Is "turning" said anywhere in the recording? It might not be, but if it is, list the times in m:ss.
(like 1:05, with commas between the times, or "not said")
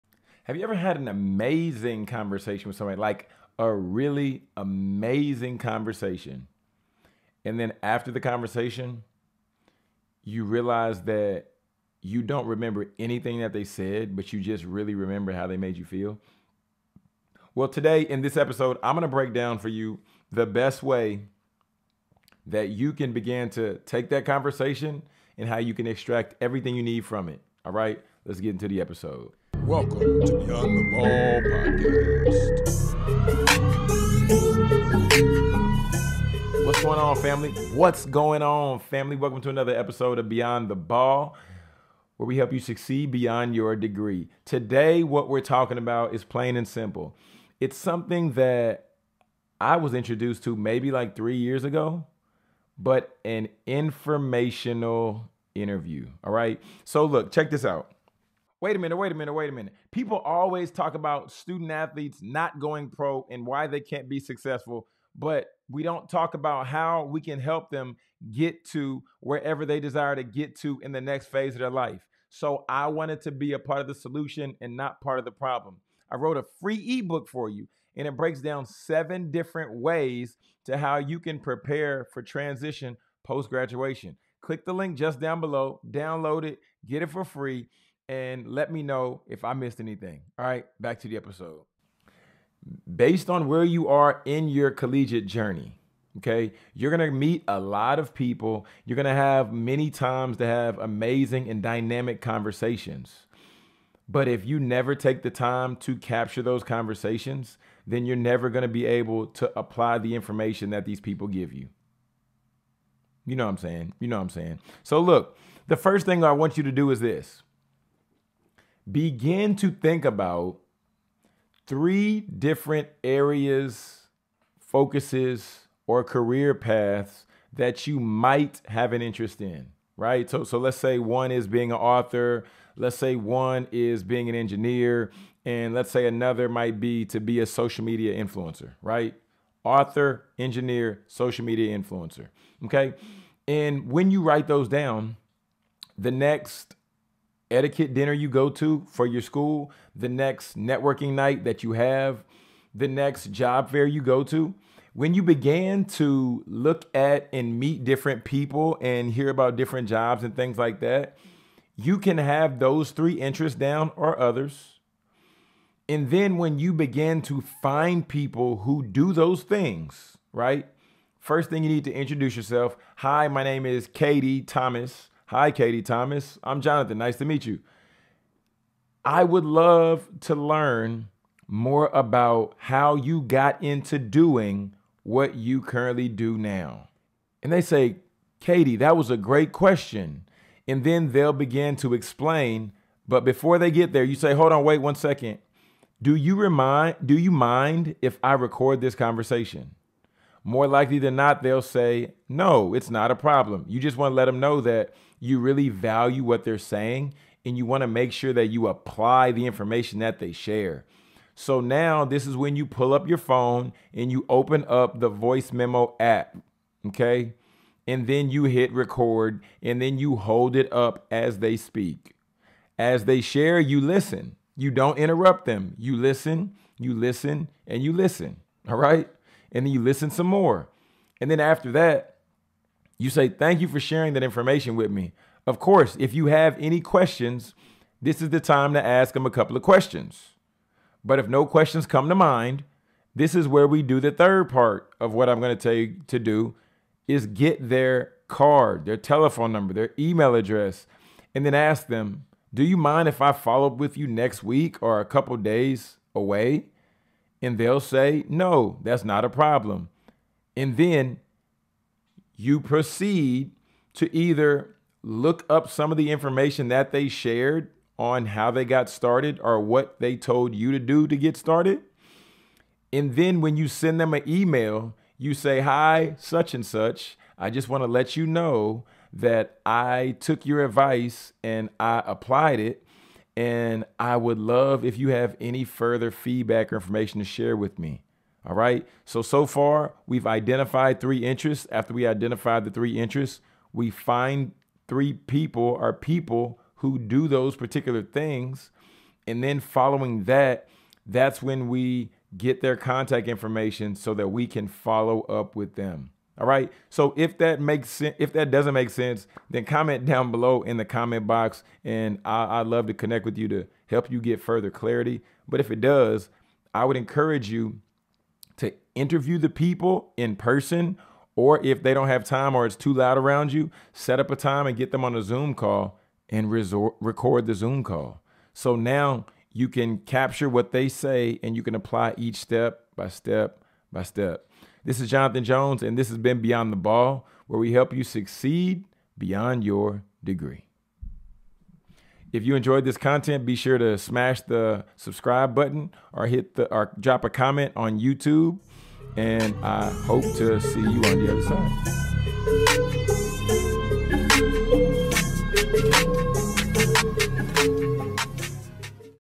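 not said.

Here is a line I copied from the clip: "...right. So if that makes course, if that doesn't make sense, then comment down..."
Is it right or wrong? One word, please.
wrong.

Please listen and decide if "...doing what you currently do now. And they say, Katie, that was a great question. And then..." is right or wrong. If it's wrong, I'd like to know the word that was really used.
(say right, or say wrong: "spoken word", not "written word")
right.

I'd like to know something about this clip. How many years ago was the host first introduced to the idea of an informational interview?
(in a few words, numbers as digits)
3.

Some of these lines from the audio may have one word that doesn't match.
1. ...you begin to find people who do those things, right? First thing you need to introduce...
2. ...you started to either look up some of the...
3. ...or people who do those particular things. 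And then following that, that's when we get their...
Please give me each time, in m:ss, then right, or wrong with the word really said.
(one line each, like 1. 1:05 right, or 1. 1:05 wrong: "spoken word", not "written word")
1. 2:46 right
2. 4:22 wrong: "proceed", not "started"
3. 4:55 right.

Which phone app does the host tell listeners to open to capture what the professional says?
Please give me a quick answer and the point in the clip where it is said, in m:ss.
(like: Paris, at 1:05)
Voice memo app, at 3:35.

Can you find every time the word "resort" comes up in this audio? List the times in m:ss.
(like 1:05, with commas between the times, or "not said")
5:26.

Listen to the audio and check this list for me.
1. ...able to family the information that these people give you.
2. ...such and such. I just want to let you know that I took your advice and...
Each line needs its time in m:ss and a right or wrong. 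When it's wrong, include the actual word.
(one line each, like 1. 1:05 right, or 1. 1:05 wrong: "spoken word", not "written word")
1. 1:48 wrong: "apply", not "family"
2. 4:36 right.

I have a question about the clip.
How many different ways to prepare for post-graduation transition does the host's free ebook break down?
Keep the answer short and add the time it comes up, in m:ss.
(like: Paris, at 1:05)
7, at 1:18.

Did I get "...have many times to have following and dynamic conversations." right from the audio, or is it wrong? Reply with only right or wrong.
wrong.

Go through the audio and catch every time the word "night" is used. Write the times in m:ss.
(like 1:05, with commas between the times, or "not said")
2:31.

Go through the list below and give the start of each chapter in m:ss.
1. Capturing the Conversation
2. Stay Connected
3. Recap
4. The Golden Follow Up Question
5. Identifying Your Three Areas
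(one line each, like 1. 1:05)
1. 1:24
2. 5:08
3. 4:50
4. 4:08
5. 2:00.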